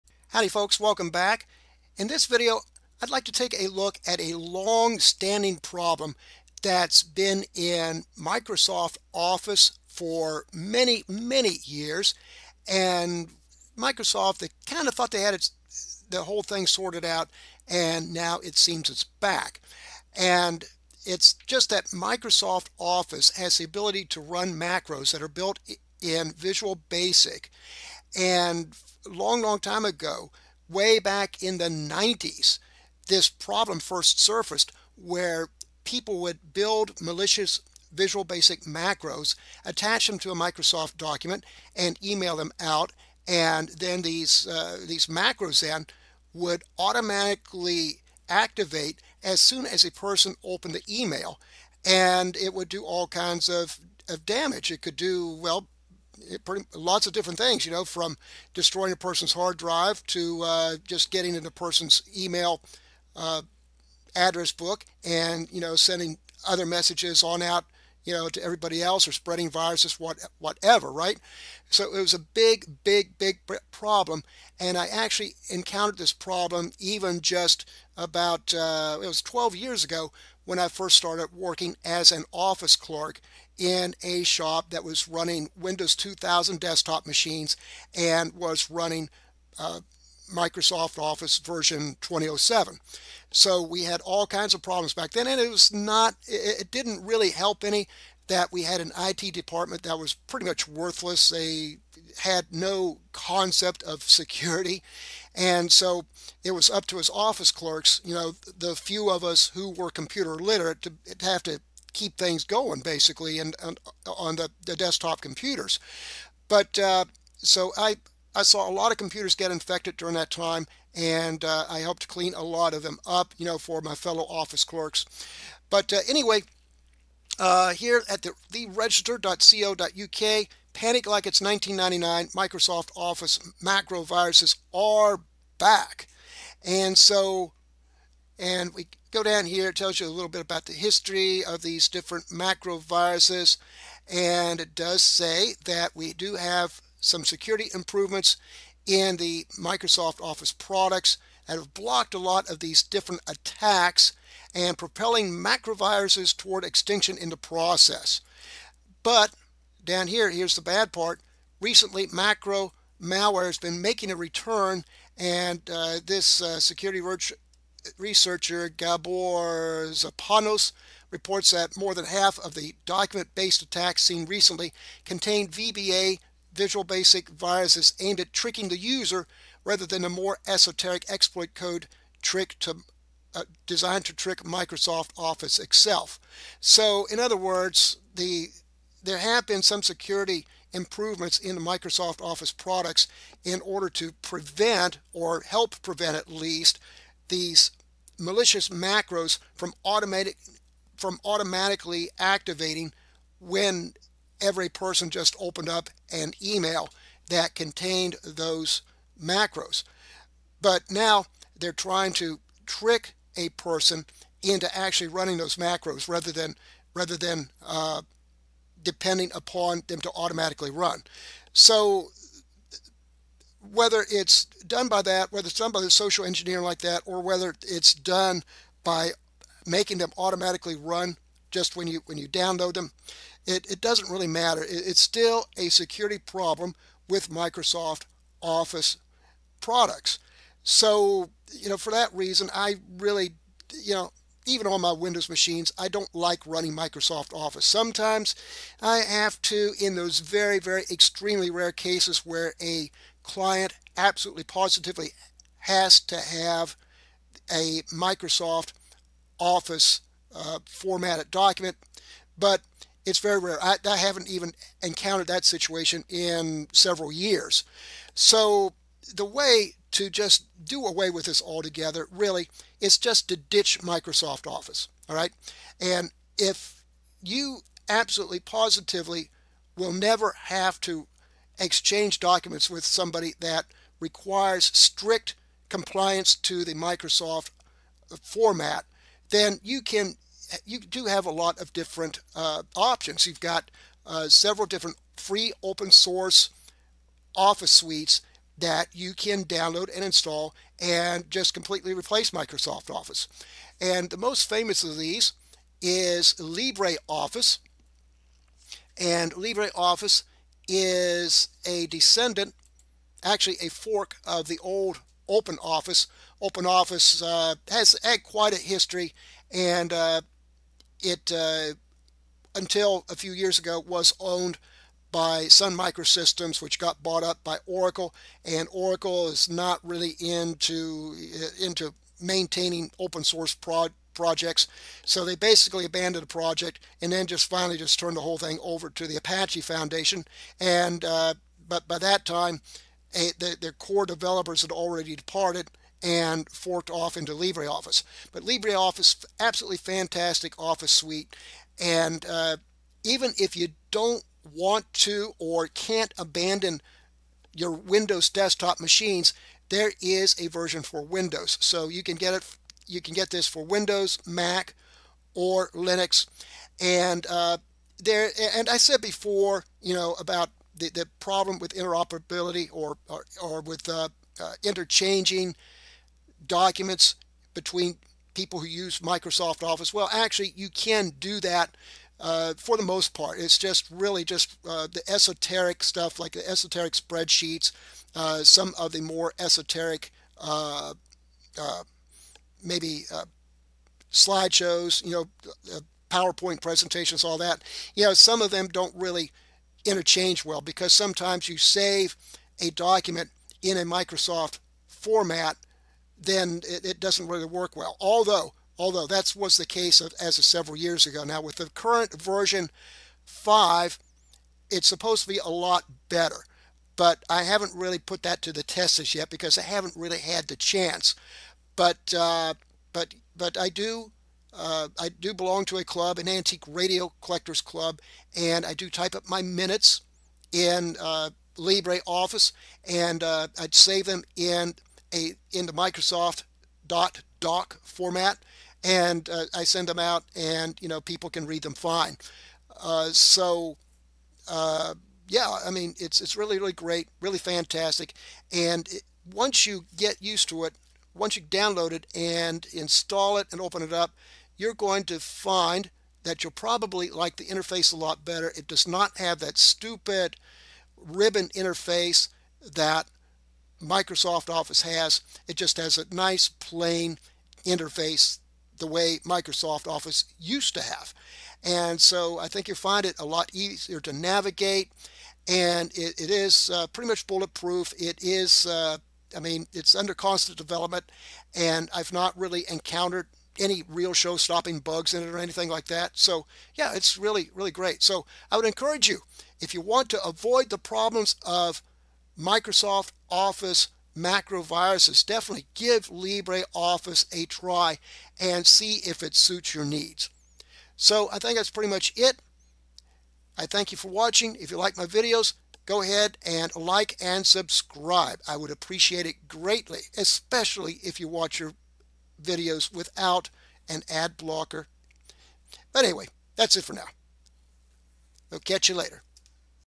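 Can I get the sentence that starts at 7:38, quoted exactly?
It does not have that stupid ribbon interface that Microsoft Office has.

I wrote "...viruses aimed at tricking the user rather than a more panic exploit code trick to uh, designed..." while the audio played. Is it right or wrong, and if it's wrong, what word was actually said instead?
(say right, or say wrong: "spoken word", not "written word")
wrong: "esoteric", not "panic".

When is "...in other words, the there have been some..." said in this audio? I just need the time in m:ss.
3:07.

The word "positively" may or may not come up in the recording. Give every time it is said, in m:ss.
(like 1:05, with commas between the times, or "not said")
4:14, 4:38.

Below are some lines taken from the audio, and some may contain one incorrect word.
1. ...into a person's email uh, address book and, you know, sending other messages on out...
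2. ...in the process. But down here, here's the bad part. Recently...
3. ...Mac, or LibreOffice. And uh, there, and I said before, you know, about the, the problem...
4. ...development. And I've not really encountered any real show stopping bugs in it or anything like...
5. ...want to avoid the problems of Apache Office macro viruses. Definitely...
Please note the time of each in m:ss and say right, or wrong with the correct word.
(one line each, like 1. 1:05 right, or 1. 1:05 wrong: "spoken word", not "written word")
1. 1:01 right
2. 2:37 right
3. 6:04 wrong: "Linux", not "LibreOffice"
4. 8:00 right
5. 8:09 wrong: "Microsoft", not "Apache".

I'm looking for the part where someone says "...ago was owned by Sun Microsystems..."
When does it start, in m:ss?
5:23.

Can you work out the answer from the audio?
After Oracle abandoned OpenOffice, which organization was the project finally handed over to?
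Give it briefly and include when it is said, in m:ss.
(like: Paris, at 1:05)
Apache Foundation, at 5:39.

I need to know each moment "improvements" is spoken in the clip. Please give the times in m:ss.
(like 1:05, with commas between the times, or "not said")
2:27, 3:10.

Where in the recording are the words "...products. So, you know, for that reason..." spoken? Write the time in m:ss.
3:59.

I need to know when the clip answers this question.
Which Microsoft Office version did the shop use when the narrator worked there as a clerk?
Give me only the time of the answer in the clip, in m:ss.
1:32.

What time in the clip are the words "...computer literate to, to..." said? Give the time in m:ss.
1:49.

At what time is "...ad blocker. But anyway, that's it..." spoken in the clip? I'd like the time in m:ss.
8:34.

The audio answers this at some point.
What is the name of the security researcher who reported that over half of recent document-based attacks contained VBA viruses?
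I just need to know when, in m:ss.
2:48.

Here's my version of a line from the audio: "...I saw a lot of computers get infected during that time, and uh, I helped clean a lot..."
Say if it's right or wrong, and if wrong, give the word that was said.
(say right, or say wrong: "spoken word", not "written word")
right.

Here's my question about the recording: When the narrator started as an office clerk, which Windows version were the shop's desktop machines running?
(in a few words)
Windows 2000.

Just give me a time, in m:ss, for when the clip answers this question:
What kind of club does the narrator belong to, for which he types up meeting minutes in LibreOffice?
7:06.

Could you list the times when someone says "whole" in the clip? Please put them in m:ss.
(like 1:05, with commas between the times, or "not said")
0:16, 5:38.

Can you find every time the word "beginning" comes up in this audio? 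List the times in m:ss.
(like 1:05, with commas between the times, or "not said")
not said.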